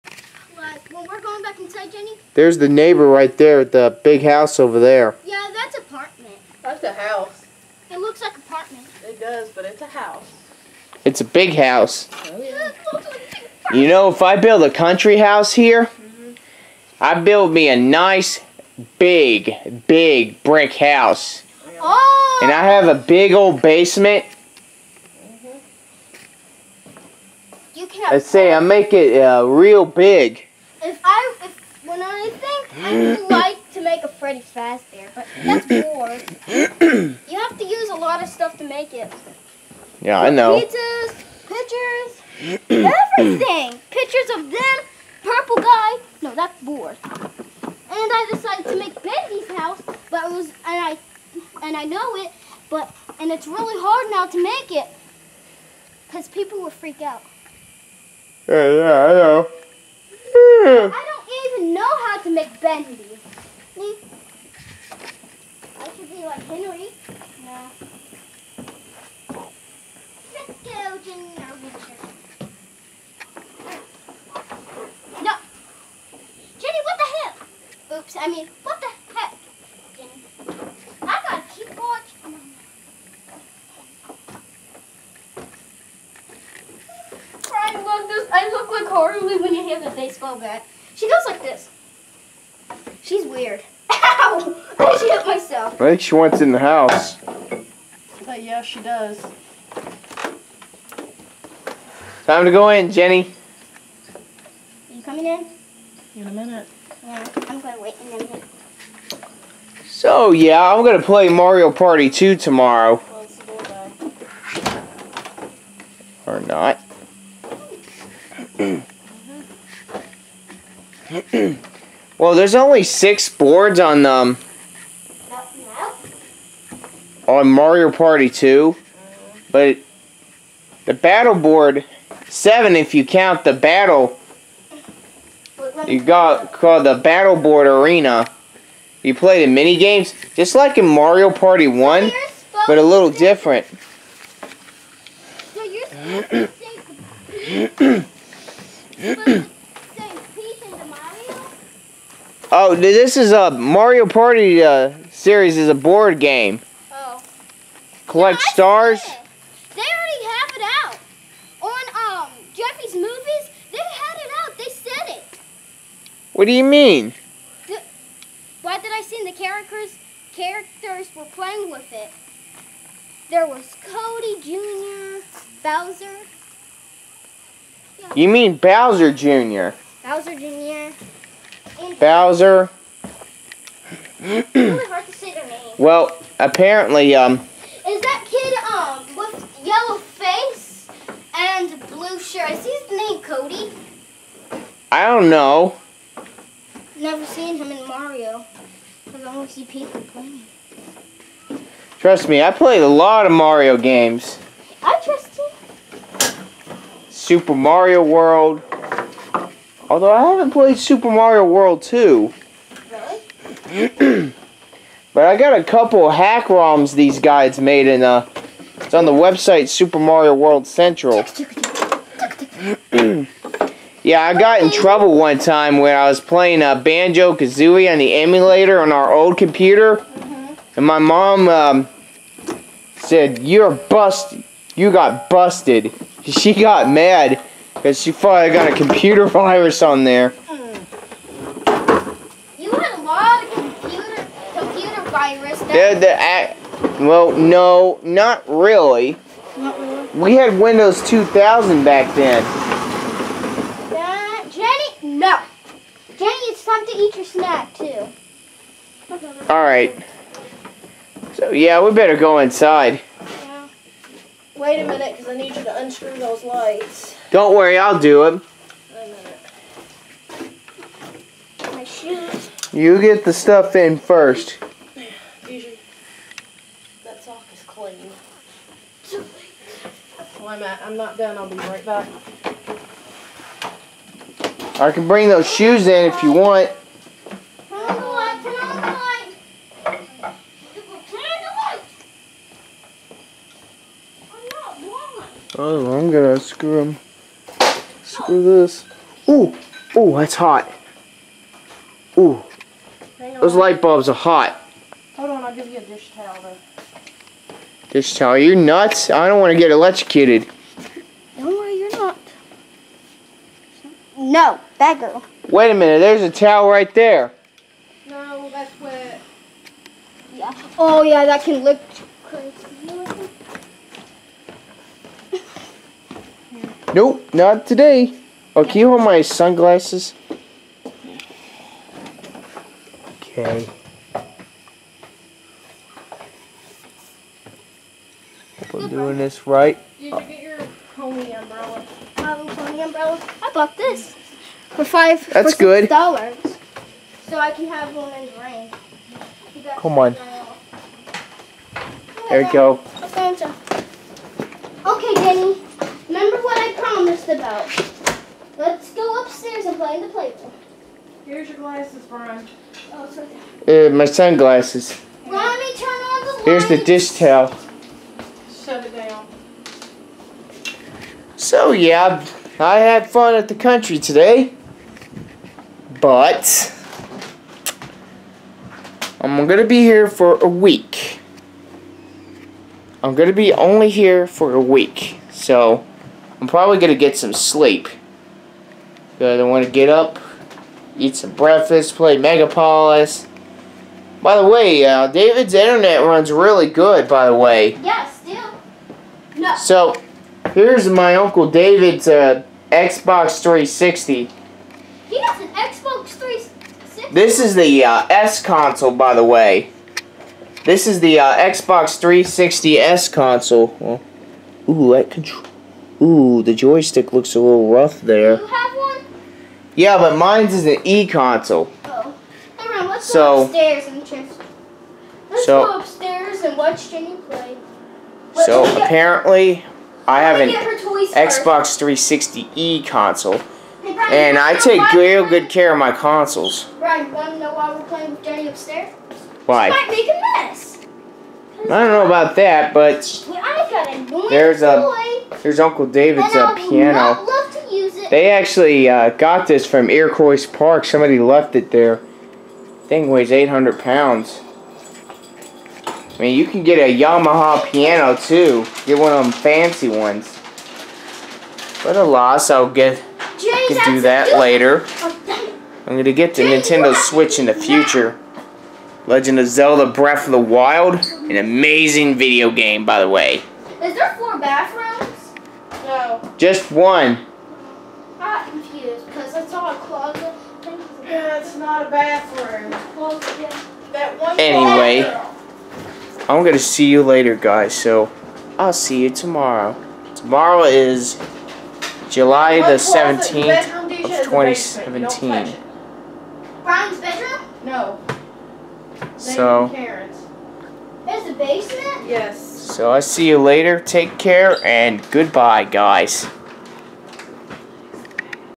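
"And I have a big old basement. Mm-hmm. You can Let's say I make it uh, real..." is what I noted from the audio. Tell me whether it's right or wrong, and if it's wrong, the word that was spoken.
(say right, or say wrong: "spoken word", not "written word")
right.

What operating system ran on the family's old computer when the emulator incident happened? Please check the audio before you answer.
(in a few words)
Windows 2000.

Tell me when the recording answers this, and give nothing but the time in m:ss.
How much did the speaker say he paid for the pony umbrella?
5:44.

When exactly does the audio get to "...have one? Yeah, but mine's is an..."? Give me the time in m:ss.
6:58.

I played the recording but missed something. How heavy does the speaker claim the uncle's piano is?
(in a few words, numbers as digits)
800 pounds.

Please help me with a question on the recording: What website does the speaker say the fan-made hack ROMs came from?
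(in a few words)
Super Mario World Central.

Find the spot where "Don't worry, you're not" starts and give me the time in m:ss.
5:11.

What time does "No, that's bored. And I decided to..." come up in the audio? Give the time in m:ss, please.
0:46.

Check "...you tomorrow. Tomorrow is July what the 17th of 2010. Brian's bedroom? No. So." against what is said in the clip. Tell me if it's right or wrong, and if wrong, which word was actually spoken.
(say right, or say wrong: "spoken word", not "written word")
wrong: "2017", not "2010".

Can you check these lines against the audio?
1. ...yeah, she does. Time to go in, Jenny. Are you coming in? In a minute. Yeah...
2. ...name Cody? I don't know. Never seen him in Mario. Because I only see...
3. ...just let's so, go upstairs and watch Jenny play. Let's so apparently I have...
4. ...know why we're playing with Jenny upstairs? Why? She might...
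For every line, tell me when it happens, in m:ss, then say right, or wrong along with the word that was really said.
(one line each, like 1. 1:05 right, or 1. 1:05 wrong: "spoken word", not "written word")
1. 1:38 right
2. 3:12 right
3. 7:04 right
4. 7:17 right.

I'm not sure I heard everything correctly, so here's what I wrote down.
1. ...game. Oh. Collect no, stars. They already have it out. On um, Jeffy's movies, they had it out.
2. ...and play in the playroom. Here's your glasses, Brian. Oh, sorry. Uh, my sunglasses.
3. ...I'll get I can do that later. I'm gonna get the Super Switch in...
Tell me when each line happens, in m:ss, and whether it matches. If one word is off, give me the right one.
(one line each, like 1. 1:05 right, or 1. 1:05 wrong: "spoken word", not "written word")
1. 2:36 right
2. 5:59 right
3. 7:42 wrong: "Nintendo", not "Super".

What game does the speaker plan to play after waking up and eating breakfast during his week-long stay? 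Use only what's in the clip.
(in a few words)
Megapolis.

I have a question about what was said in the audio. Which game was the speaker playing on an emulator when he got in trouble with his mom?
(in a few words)
Banjo Kazooie.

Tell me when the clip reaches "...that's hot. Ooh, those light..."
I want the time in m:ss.
5:00.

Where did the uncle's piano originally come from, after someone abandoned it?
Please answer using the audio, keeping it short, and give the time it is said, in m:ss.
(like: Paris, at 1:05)
Iroquois Park, at 7:29.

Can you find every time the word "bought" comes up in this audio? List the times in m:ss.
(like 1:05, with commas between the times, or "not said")
5:43.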